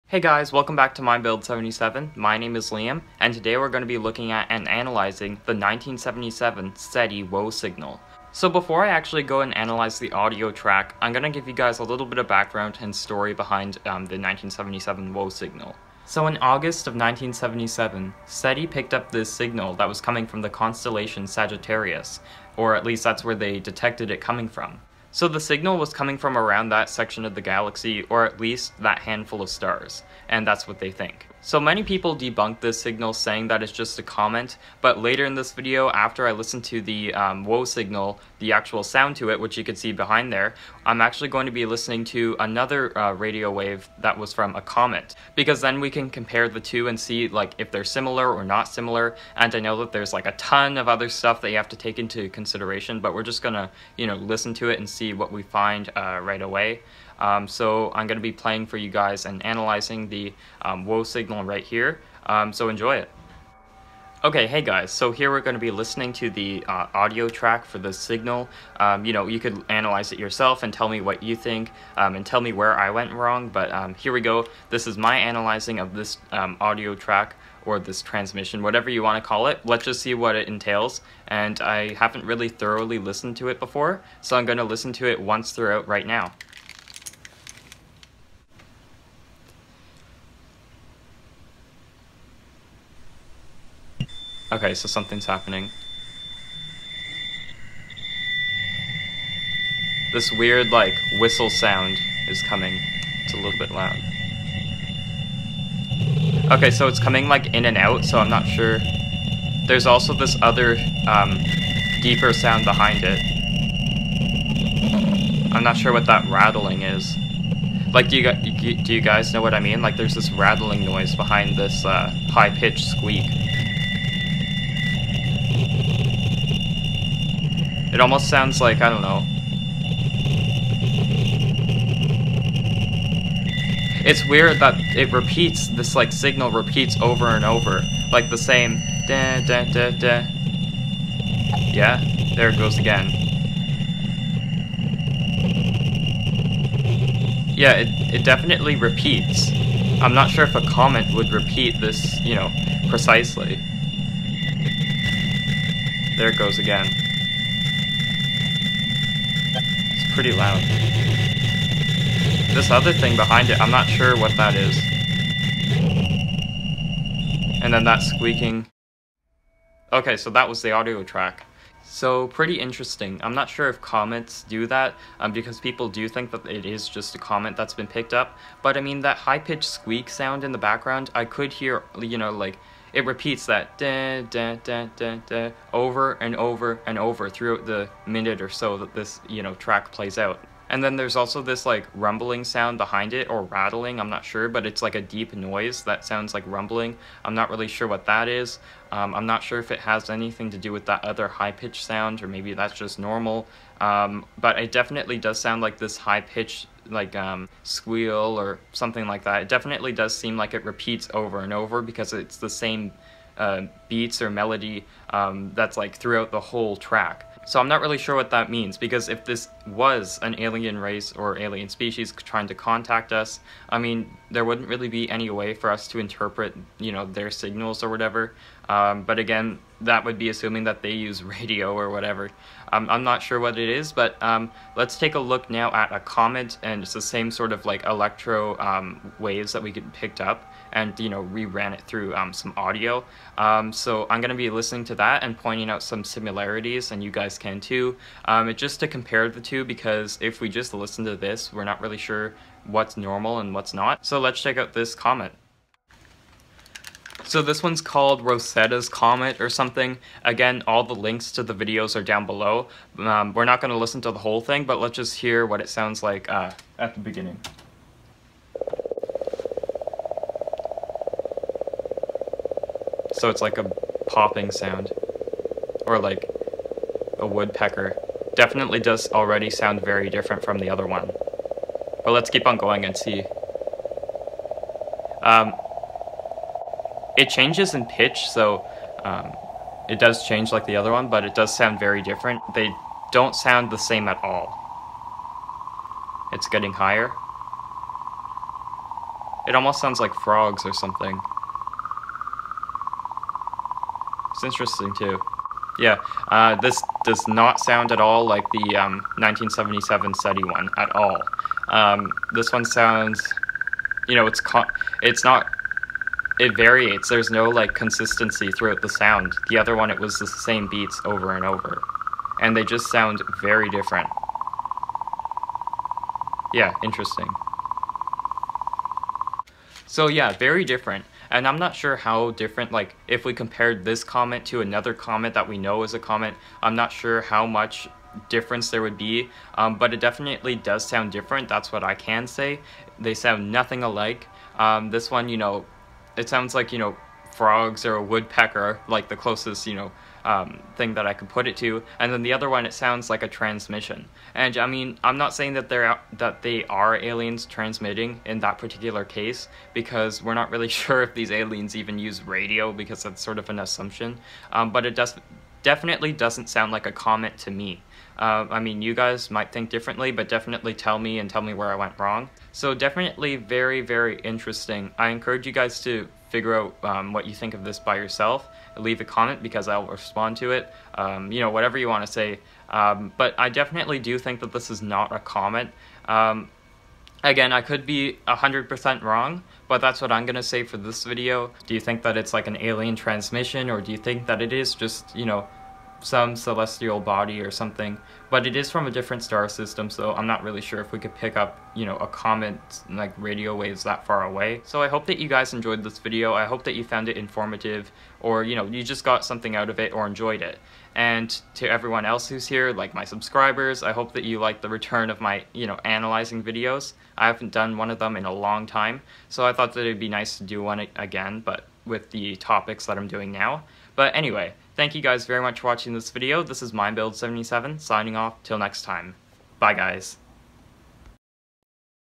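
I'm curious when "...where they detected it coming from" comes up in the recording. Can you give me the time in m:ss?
0:23.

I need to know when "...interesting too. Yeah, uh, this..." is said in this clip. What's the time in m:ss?
5:04.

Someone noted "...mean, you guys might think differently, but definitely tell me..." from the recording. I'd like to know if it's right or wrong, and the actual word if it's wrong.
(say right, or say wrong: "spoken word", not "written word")
right.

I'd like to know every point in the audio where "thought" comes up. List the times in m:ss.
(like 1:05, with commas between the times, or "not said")
6:59.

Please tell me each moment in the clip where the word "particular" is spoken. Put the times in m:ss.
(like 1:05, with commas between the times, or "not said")
5:58.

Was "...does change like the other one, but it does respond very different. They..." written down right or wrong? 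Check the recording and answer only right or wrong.
wrong.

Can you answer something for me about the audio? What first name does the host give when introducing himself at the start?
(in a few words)
Liam.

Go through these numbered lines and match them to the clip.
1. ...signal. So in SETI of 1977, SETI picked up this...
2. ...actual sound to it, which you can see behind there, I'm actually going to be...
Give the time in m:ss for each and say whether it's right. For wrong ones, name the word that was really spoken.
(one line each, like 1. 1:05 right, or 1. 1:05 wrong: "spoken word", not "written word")
1. 0:15 wrong: "August", not "SETI"
2. 0:38 right.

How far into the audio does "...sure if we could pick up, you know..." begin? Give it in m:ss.
6:40.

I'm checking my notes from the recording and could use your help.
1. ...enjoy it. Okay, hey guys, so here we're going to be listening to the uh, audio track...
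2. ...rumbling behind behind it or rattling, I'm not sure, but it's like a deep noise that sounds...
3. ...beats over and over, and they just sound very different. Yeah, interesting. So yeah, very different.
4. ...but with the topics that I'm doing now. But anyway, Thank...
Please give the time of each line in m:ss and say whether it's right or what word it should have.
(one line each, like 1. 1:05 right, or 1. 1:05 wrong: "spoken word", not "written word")
1. 1:02 right
2. 3:11 wrong: "sound", not "behind"
3. 5:20 right
4. 7:01 right.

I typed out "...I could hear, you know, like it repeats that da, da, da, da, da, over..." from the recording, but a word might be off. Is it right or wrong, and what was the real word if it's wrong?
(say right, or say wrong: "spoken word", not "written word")
right.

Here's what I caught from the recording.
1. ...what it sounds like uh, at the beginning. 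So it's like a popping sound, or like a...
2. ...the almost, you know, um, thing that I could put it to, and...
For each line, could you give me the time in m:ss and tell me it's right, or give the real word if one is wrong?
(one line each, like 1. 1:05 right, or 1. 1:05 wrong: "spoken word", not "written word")
1. 4:25 right
2. 5:49 wrong: "closest", not "almost".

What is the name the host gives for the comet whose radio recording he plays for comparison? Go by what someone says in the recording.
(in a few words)
Rosetta's Comet.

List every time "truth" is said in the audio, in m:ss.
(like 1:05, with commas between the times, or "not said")
not said.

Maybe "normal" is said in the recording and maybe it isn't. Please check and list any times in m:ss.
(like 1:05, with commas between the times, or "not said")
3:22, 4:12.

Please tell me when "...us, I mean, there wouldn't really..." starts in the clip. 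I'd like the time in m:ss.
3:43.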